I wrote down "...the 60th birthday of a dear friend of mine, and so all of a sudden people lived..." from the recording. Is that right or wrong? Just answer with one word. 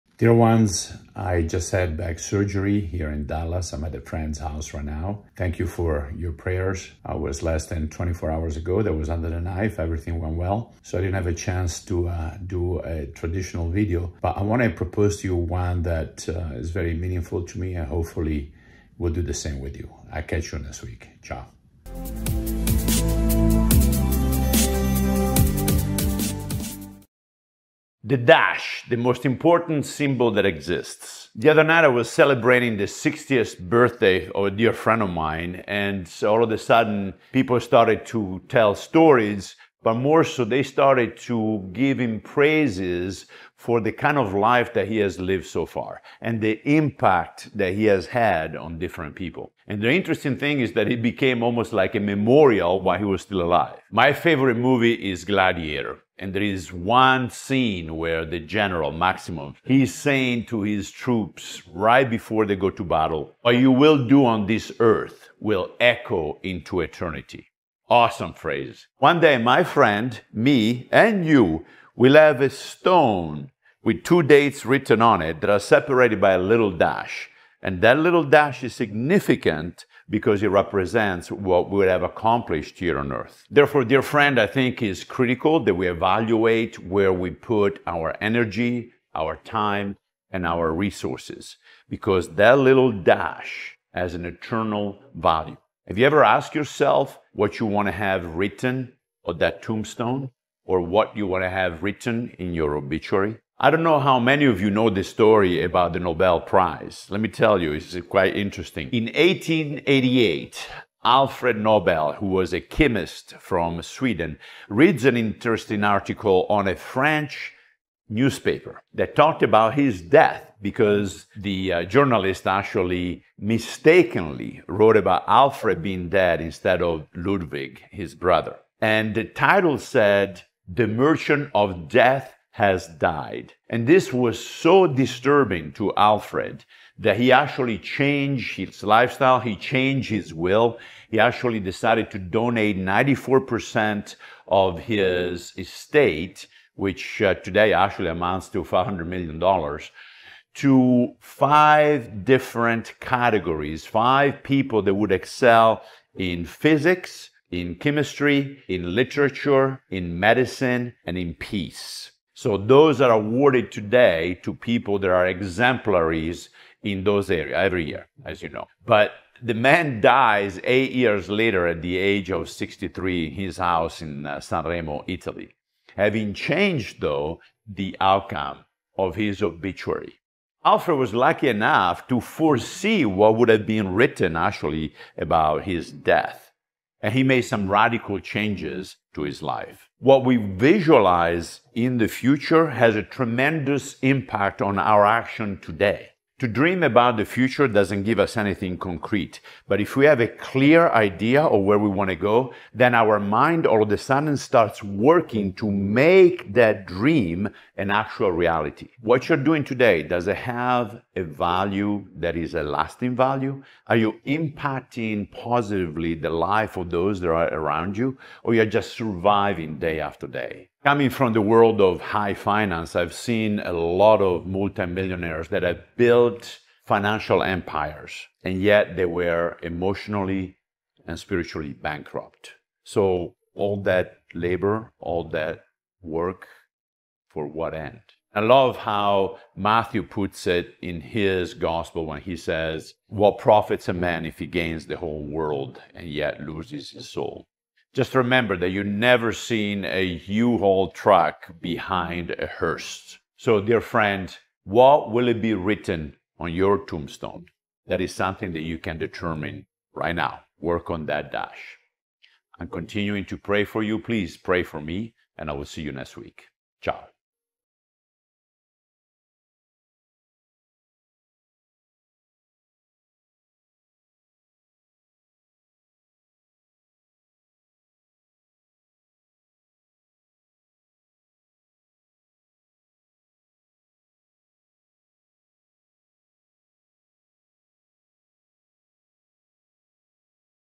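wrong.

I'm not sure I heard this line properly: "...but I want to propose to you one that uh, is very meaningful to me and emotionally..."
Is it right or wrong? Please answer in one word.
wrong.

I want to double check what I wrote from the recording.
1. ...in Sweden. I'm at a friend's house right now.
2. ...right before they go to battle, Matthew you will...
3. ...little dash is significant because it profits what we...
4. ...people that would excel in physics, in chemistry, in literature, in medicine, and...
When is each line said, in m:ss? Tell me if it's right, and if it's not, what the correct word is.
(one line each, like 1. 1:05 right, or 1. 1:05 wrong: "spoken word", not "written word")
1. 0:03 wrong: "Dallas", not "Sweden"
2. 1:01 wrong: "What", not "Matthew"
3. 1:17 wrong: "represents", not "profits"
4. 2:34 right.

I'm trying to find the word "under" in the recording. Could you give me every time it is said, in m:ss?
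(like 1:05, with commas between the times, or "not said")
0:09.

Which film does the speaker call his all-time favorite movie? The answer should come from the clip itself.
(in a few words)
Gladiator.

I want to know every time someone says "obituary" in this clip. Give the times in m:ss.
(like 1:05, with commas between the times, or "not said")
1:42, 2:59.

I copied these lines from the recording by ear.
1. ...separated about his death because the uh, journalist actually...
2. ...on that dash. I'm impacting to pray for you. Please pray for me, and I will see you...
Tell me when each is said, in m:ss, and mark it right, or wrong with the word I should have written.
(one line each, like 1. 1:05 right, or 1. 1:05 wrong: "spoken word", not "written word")
1. 1:59 wrong: "talked", not "separated"
2. 4:20 wrong: "continuing", not "impacting".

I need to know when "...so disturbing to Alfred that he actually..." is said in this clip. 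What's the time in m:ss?
2:14.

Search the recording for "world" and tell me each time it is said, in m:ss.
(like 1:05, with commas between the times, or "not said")
3:41, 4:05.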